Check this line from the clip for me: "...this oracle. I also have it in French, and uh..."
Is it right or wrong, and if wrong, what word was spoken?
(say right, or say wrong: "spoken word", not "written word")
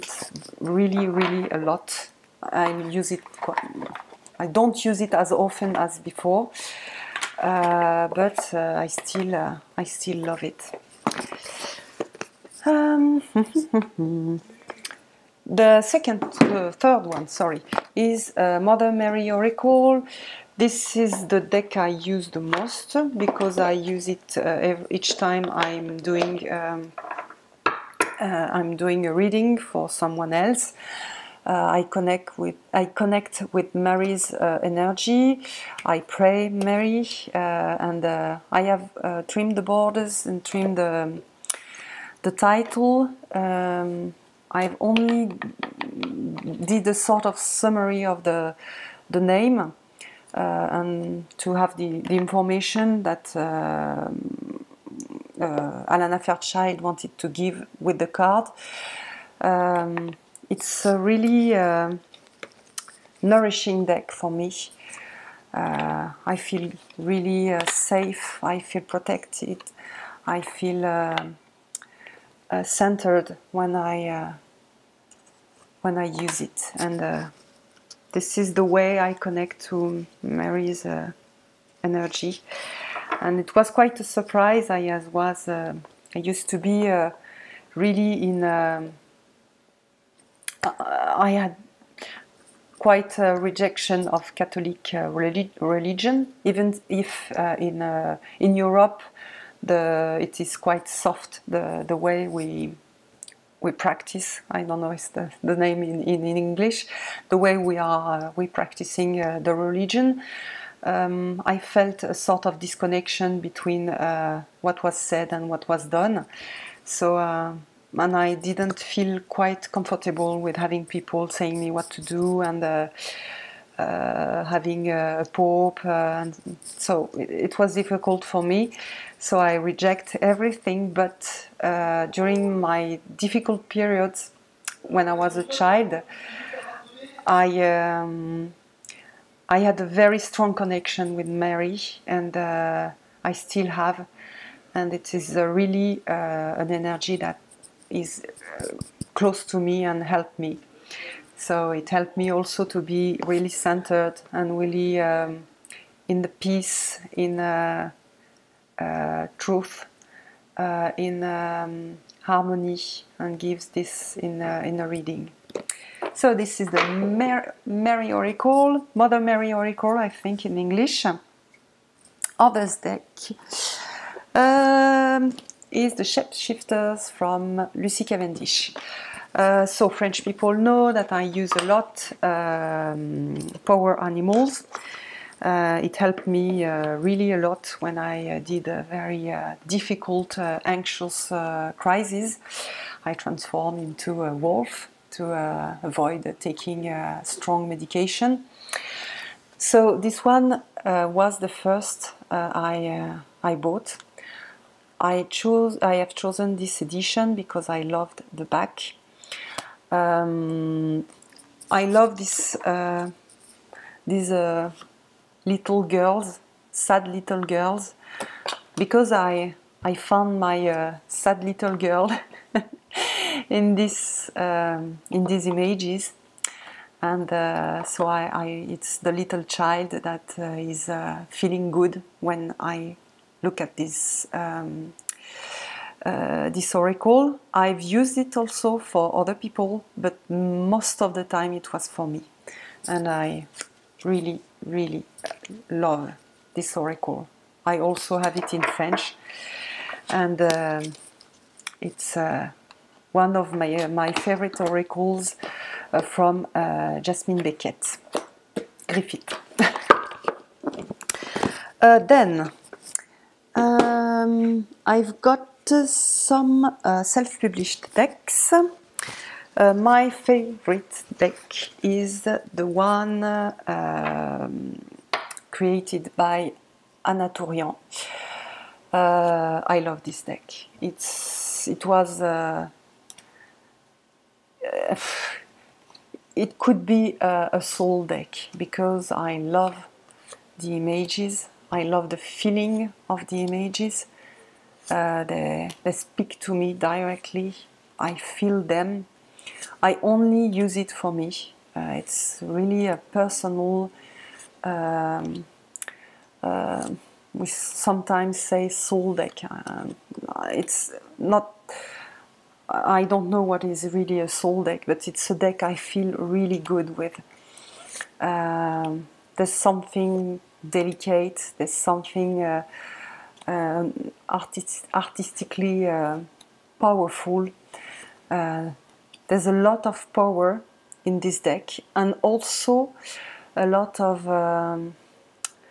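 right.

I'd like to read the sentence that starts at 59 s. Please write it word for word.
Um, it's a really uh, nourishing deck for me.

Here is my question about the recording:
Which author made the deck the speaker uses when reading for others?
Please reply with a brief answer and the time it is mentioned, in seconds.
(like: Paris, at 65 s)
Alana Fairchild, at 55 s.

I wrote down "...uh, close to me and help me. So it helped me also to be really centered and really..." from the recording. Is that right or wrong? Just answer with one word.
right.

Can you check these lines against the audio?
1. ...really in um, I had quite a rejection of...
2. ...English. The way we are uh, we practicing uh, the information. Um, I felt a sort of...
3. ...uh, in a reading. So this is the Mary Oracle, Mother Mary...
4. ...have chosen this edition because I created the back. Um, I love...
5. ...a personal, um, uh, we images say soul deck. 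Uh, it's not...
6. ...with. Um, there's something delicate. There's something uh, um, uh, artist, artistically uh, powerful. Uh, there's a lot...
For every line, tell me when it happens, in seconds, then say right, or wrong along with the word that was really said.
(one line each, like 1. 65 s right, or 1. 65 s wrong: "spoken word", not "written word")
1. 87 s right
2. 106 s wrong: "religion", not "information"
3. 164 s right
4. 205 s wrong: "loved", not "created"
5. 302 s wrong: "sometimes", not "images"
6. 316 s right.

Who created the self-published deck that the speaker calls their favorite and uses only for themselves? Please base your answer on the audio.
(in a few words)
Anna Tourian.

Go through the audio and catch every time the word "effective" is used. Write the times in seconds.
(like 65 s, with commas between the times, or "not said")
not said.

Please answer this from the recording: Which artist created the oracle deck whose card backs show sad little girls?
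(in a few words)
Jasmine Becket Griffith.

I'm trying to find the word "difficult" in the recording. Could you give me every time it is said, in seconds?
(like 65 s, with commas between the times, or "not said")
127 s, 133 s, 189 s.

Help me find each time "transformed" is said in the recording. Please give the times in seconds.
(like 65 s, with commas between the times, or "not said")
193 s.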